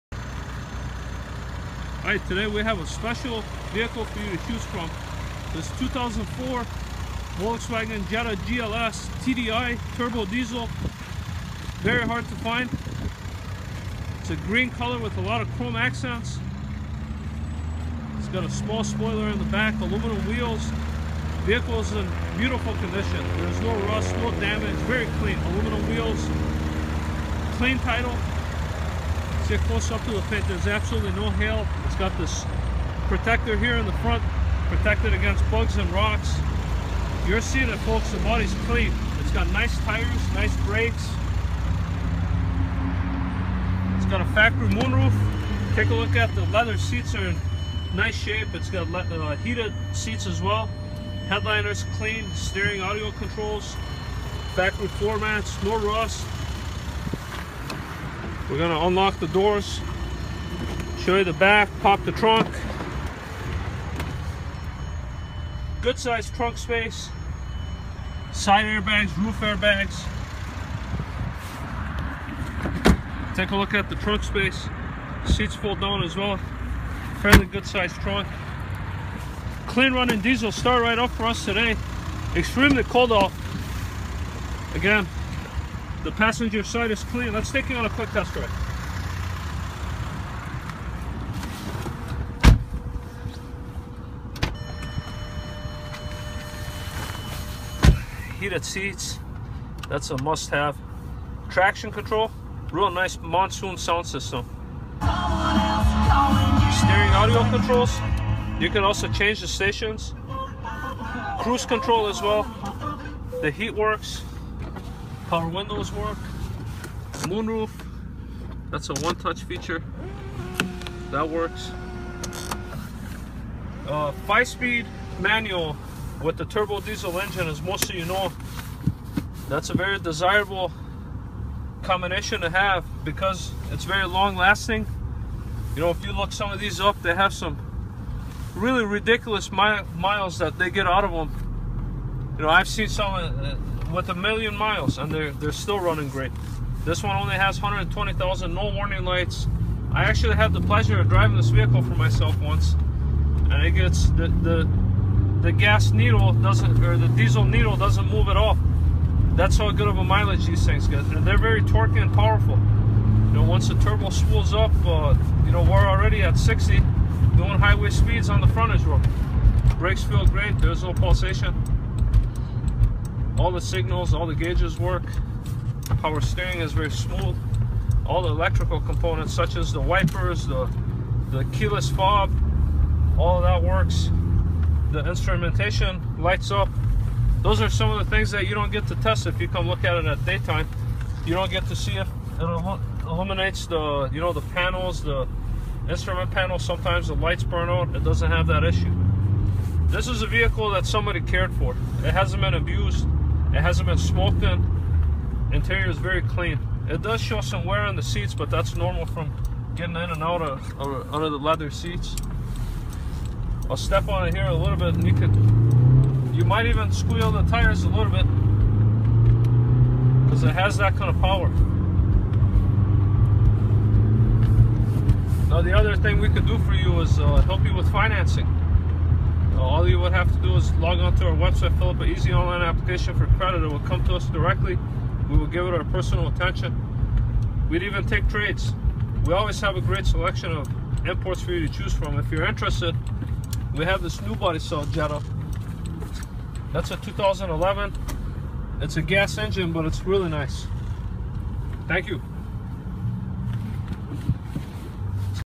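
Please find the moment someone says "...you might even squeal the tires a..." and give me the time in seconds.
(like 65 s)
216 s.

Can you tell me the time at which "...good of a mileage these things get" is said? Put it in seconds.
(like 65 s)
159 s.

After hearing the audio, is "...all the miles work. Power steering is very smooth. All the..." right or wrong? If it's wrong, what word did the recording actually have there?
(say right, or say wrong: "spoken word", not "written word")
wrong: "gauges", not "miles".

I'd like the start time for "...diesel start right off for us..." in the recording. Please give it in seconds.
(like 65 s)
80 s.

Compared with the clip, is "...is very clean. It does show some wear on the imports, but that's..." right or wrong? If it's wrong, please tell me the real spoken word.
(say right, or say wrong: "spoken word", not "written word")
wrong: "seats", not "imports".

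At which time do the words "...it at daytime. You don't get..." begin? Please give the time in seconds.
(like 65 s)
189 s.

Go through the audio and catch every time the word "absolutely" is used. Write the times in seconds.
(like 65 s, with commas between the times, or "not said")
30 s.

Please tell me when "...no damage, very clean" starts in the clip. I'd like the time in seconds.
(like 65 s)
24 s.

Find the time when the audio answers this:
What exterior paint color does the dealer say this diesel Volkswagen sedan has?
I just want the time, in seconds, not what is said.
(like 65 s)
14 s.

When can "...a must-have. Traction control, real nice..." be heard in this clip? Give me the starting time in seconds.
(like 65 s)
100 s.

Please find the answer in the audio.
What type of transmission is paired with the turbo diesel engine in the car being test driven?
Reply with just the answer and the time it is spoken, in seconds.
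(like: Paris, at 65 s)
Five-speed manual, at 124 s.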